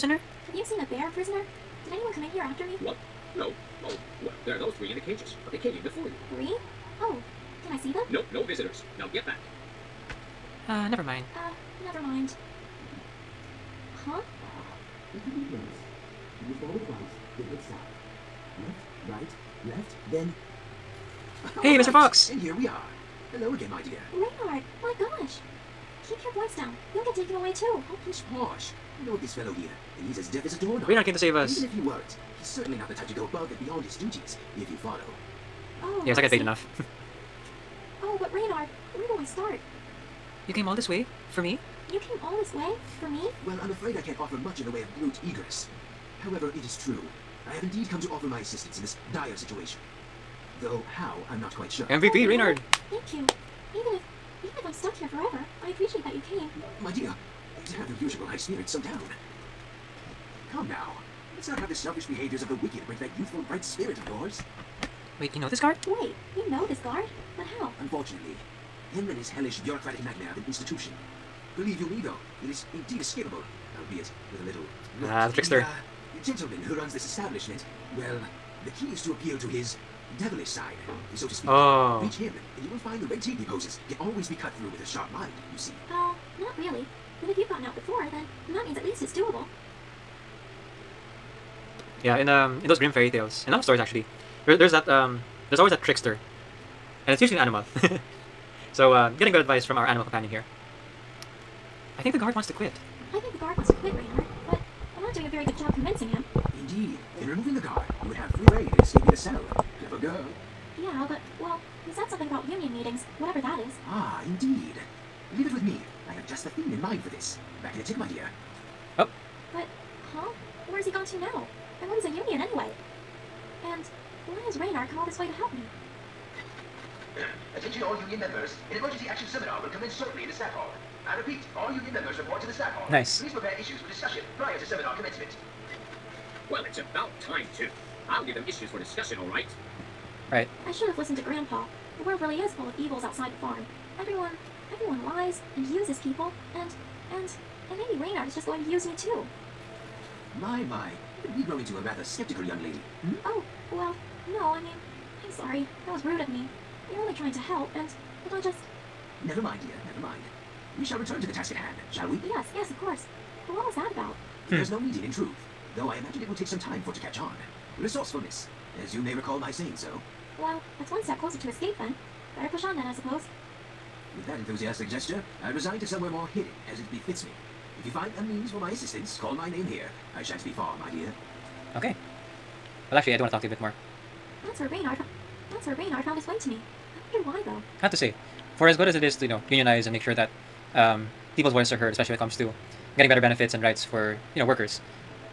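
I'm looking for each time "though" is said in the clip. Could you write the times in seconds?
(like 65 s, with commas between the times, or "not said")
50 s, 72 s, 165 s, 187 s.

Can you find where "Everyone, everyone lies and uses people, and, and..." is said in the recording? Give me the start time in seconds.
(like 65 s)
143 s.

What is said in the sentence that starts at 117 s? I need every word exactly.
Back in a tick, my dear.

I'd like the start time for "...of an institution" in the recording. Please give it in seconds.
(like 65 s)
70 s.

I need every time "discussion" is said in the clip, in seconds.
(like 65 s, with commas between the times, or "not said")
133 s, 138 s.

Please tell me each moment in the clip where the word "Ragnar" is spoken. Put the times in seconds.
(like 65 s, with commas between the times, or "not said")
30 s, 38 s.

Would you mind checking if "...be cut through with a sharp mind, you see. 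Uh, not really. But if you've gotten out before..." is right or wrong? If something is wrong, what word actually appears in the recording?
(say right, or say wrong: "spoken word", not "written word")
right.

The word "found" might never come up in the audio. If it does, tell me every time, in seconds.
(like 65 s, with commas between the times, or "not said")
186 s.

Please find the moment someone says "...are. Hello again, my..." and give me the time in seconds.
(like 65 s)
22 s.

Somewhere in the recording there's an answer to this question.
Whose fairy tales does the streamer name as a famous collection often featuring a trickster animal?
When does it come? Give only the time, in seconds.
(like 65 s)
92 s.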